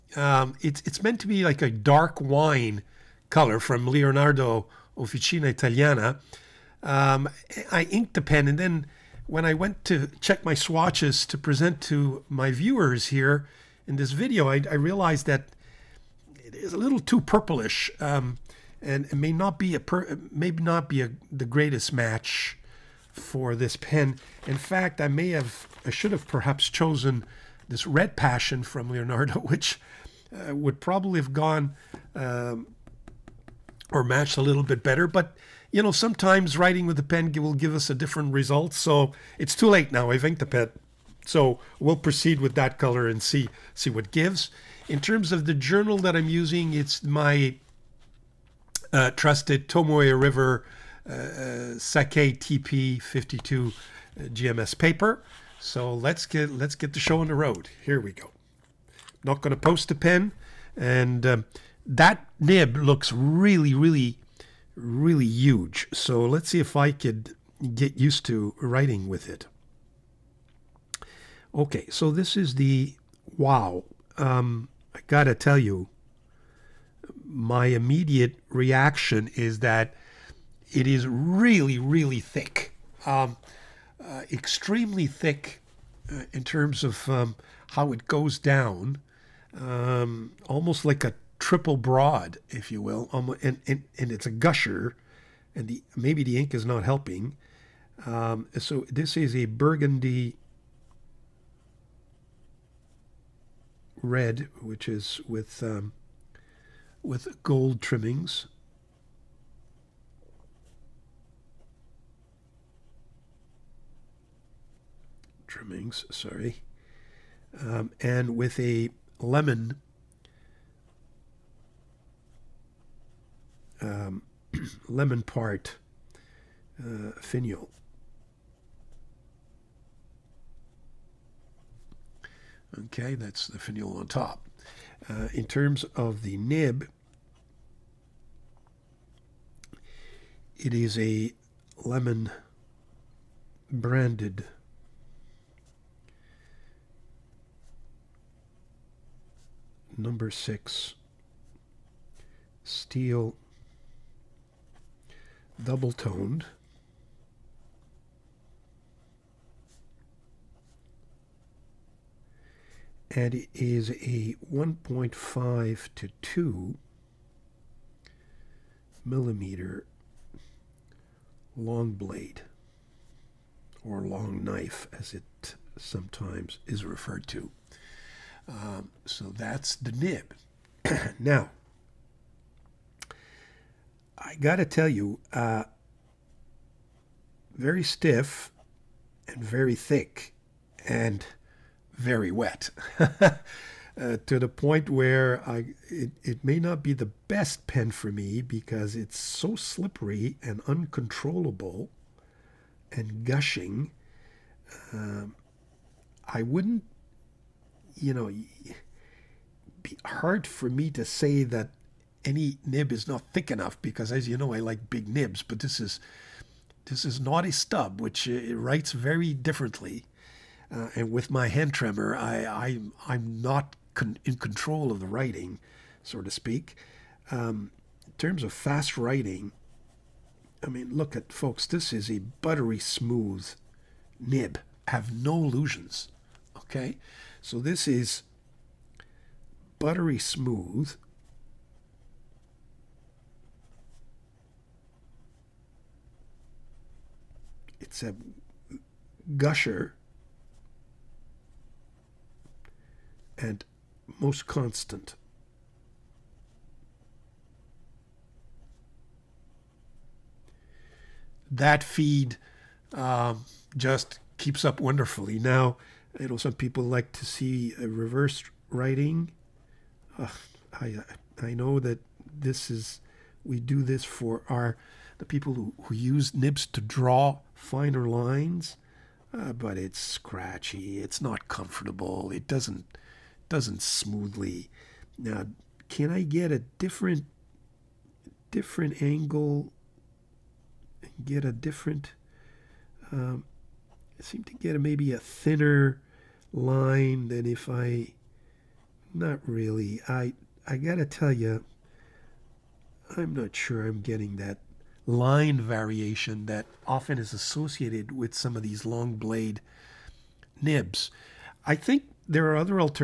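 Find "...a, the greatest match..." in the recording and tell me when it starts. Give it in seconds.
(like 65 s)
21 s.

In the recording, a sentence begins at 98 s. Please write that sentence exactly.
Um, so this is a burgundy red, which is with um, with gold trimmings.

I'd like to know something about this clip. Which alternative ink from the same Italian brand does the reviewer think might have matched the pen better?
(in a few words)
Red Passion.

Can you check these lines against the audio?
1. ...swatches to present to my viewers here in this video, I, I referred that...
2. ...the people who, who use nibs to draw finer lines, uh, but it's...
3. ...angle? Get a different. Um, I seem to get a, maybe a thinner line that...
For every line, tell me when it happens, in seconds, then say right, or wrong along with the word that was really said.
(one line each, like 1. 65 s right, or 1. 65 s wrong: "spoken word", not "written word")
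1. 10 s wrong: "realized", not "referred"
2. 275 s right
3. 289 s right.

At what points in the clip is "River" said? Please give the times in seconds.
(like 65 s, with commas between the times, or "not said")
50 s.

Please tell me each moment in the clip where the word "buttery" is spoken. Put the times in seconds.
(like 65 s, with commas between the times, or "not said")
232 s, 239 s.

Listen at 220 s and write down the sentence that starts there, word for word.
Uh, and with my hand tremor, I, I I'm not con- in control of the writing, so to speak.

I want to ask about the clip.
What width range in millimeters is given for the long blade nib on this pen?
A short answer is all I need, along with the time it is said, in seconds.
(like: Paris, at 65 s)
1.5 to 2 mm, at 164 s.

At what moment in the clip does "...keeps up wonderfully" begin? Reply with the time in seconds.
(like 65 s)
264 s.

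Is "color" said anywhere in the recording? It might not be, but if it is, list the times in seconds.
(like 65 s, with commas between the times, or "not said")
3 s, 42 s.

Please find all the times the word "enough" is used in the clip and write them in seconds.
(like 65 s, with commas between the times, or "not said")
213 s.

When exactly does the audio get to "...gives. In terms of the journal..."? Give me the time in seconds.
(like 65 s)
44 s.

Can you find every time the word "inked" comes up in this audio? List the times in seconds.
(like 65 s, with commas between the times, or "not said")
7 s, 40 s.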